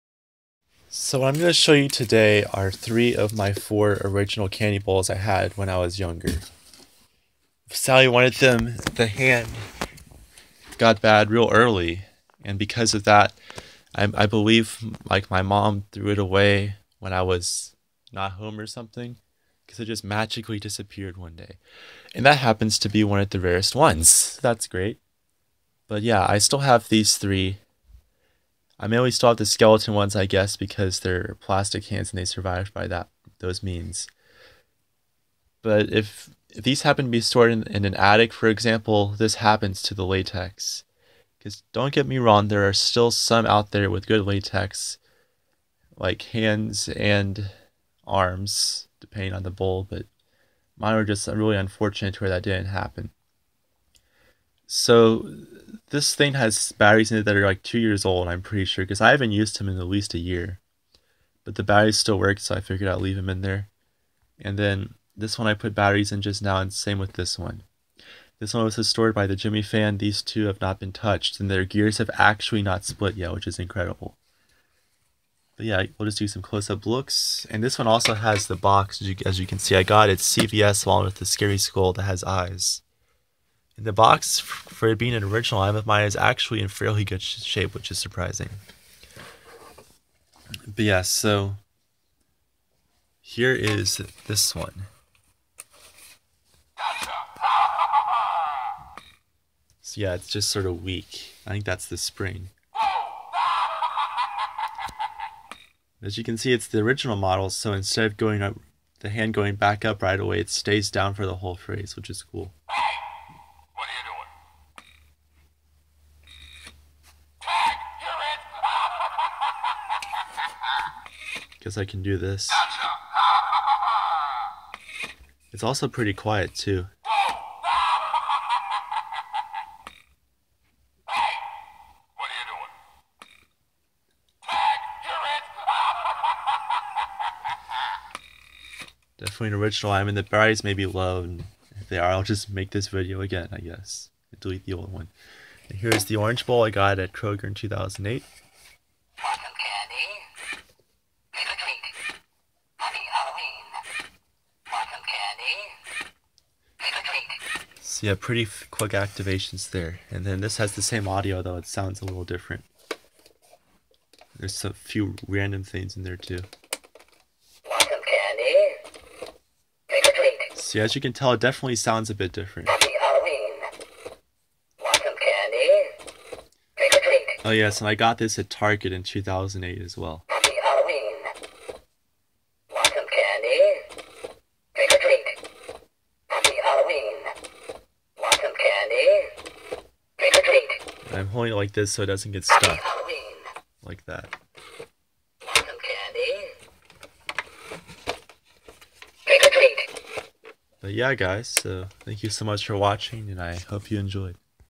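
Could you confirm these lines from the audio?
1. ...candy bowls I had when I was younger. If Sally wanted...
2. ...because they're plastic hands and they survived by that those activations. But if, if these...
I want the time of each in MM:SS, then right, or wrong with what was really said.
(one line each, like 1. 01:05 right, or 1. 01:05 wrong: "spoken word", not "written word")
1. 00:04 right
2. 00:30 wrong: "means", not "activations".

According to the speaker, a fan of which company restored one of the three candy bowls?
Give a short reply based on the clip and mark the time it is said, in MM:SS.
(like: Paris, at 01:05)
Gemmy, at 01:09.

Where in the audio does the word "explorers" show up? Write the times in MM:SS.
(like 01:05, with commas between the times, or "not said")
not said.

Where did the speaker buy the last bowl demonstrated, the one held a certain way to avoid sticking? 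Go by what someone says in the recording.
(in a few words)
Target.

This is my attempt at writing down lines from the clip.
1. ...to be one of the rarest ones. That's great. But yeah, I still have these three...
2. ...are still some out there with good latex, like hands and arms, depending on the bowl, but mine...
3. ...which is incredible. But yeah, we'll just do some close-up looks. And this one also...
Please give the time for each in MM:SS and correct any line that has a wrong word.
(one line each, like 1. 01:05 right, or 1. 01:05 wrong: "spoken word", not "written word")
1. 00:22 right
2. 00:42 right
3. 01:13 right.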